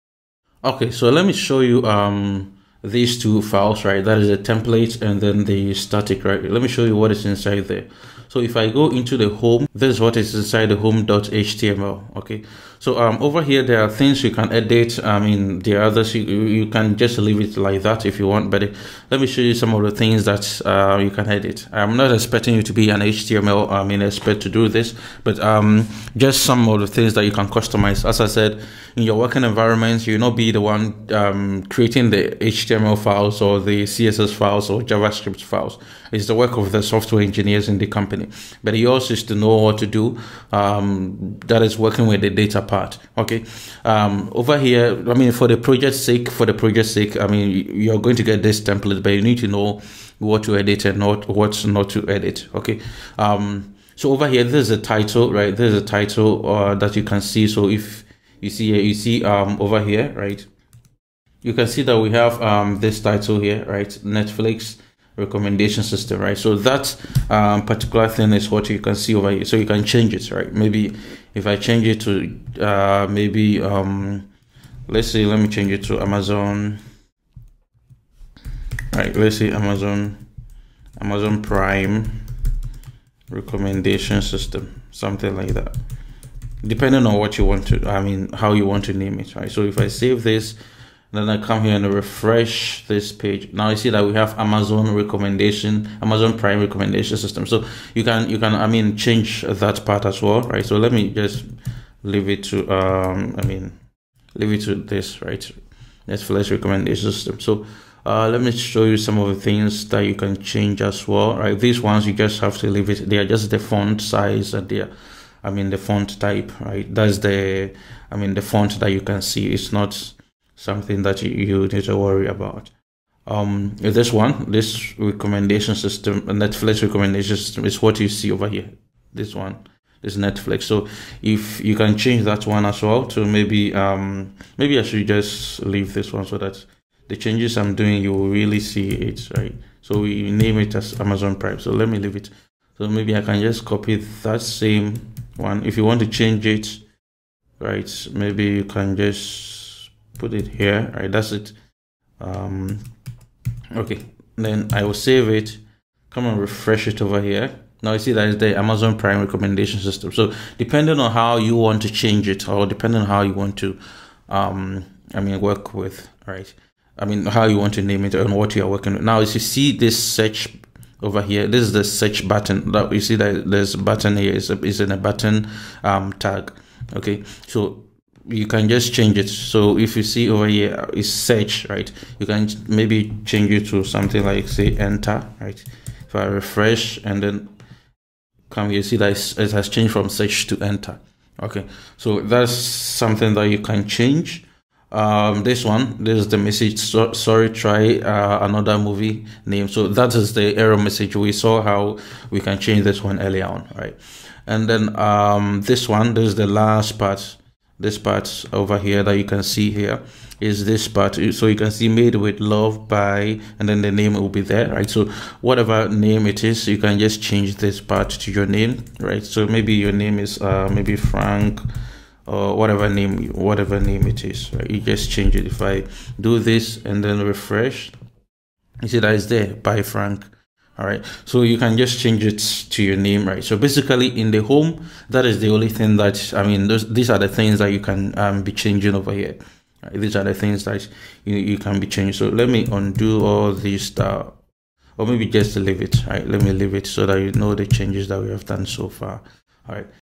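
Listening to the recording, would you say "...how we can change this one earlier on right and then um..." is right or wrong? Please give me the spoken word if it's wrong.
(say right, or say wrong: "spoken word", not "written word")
right.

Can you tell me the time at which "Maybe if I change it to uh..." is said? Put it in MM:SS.
01:10.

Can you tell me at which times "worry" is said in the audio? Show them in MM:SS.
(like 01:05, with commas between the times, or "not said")
02:01.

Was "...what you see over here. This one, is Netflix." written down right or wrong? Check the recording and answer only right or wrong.
right.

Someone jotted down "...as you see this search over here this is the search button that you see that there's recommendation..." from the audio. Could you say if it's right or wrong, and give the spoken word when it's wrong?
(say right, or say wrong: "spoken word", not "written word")
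wrong: "button", not "recommendation".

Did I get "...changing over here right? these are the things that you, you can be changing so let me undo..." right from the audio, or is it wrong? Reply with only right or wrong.
right.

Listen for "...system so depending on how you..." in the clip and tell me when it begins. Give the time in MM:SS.
02:39.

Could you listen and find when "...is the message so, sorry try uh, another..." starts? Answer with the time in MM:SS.
03:16.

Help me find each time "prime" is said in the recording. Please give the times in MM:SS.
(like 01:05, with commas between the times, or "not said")
01:21, 01:36, 02:21, 02:38.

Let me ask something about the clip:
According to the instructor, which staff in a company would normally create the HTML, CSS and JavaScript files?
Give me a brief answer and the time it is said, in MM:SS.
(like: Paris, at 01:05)
software engineers, at 00:36.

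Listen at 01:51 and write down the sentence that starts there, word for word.
These ones you just have to leave it.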